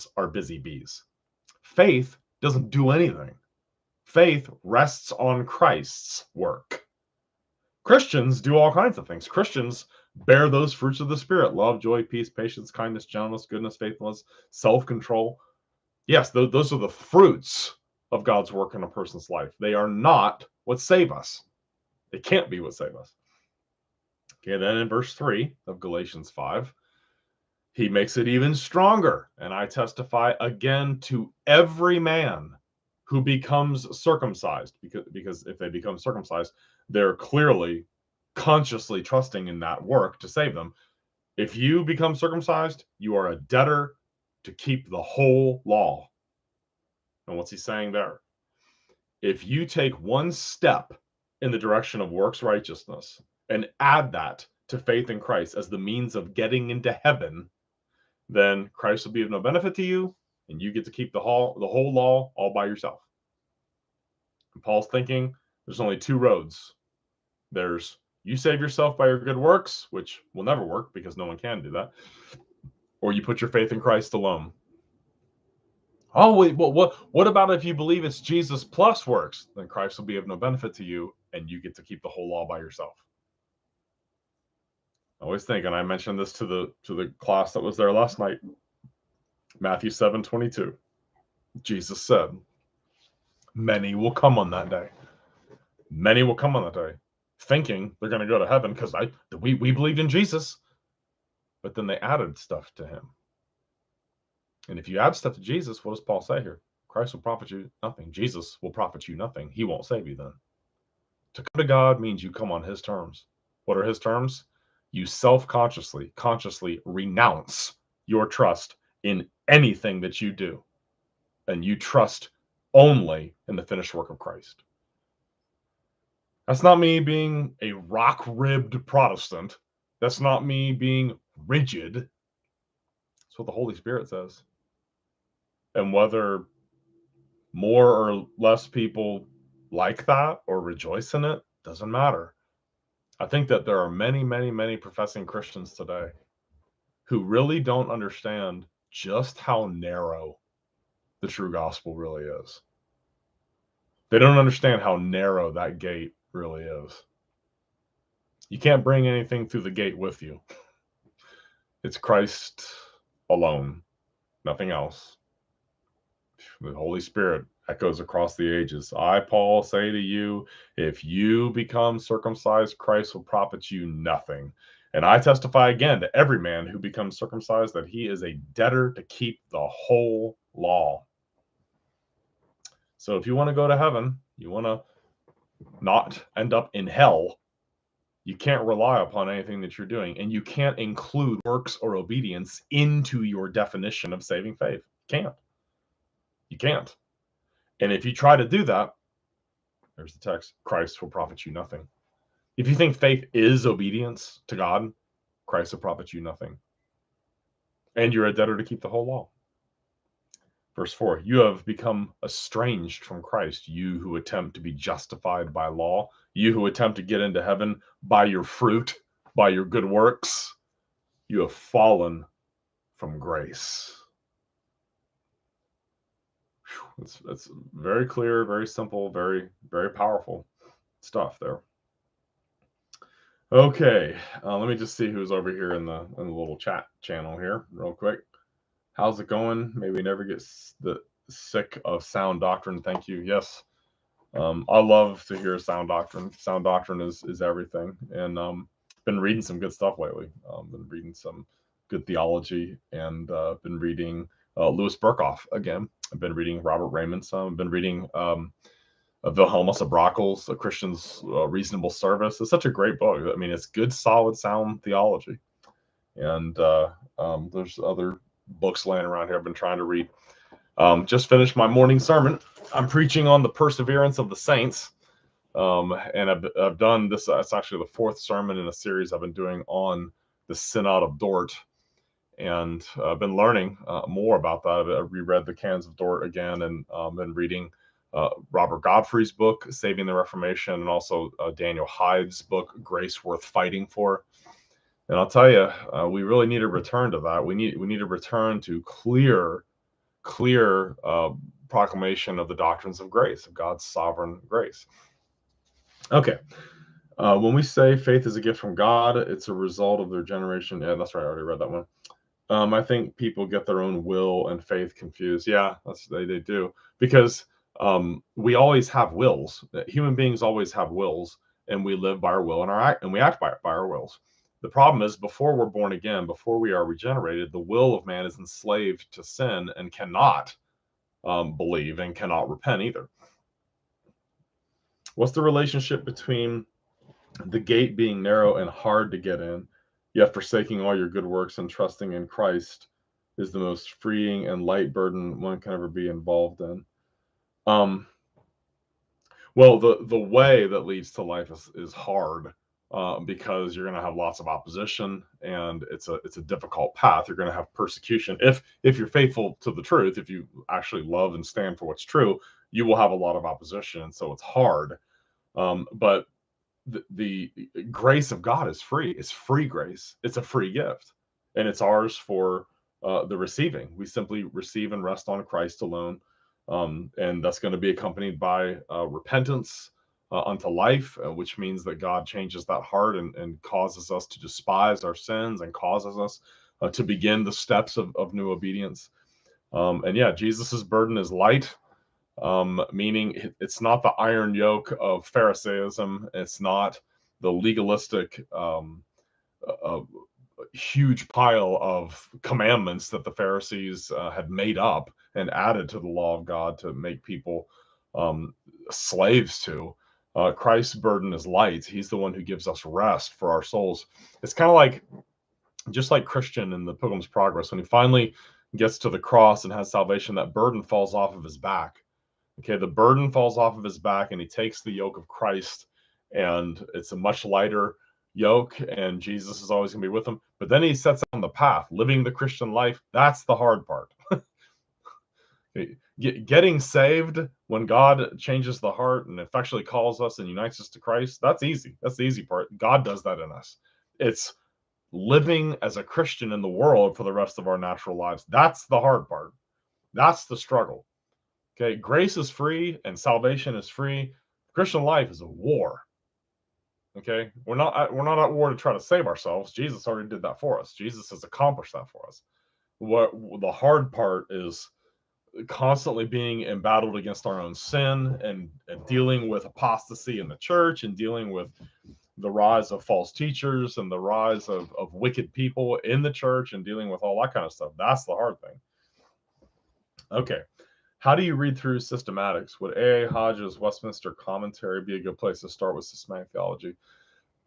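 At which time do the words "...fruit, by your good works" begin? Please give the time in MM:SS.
03:38.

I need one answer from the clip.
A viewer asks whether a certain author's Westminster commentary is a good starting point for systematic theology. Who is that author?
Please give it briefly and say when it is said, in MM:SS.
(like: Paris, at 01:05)
A.A. Hodge, at 08:02.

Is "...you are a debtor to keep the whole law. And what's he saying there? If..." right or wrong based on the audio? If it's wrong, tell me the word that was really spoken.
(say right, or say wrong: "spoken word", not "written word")
right.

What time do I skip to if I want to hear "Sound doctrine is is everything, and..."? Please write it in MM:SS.
04:06.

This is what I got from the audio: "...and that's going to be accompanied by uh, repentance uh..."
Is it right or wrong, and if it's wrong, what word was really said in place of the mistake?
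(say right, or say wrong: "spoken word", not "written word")
right.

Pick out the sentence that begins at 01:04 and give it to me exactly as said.
And Paul's thinking there's only two roads.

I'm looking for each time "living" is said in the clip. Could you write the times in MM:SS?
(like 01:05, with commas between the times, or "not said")
07:11, 07:25.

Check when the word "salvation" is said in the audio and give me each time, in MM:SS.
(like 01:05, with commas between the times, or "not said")
06:59, 07:33.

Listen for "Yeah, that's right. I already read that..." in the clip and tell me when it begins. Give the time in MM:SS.
05:10.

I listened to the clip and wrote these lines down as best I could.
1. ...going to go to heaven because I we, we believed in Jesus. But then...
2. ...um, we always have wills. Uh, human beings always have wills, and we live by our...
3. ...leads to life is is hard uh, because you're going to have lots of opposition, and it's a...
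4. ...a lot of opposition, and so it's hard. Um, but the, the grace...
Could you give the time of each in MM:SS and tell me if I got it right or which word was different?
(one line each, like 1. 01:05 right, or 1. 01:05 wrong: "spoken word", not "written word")
1. 01:38 right
2. 05:17 right
3. 05:50 right
4. 06:03 right.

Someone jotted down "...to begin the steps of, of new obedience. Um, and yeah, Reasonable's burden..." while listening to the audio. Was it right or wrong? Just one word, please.
wrong.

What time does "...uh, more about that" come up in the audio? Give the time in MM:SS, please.
04:43.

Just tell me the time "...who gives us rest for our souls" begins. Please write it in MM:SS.
06:52.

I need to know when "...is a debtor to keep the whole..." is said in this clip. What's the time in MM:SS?
02:58.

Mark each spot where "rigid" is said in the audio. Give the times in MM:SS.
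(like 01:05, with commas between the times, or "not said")
02:11.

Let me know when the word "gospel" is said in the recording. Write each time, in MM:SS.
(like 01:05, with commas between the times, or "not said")
02:31.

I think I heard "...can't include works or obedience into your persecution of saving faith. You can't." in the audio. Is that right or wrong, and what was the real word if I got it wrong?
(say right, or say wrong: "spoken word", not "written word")
wrong: "definition", not "persecution".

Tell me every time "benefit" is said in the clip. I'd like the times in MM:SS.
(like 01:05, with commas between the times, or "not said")
00:59, 01:20.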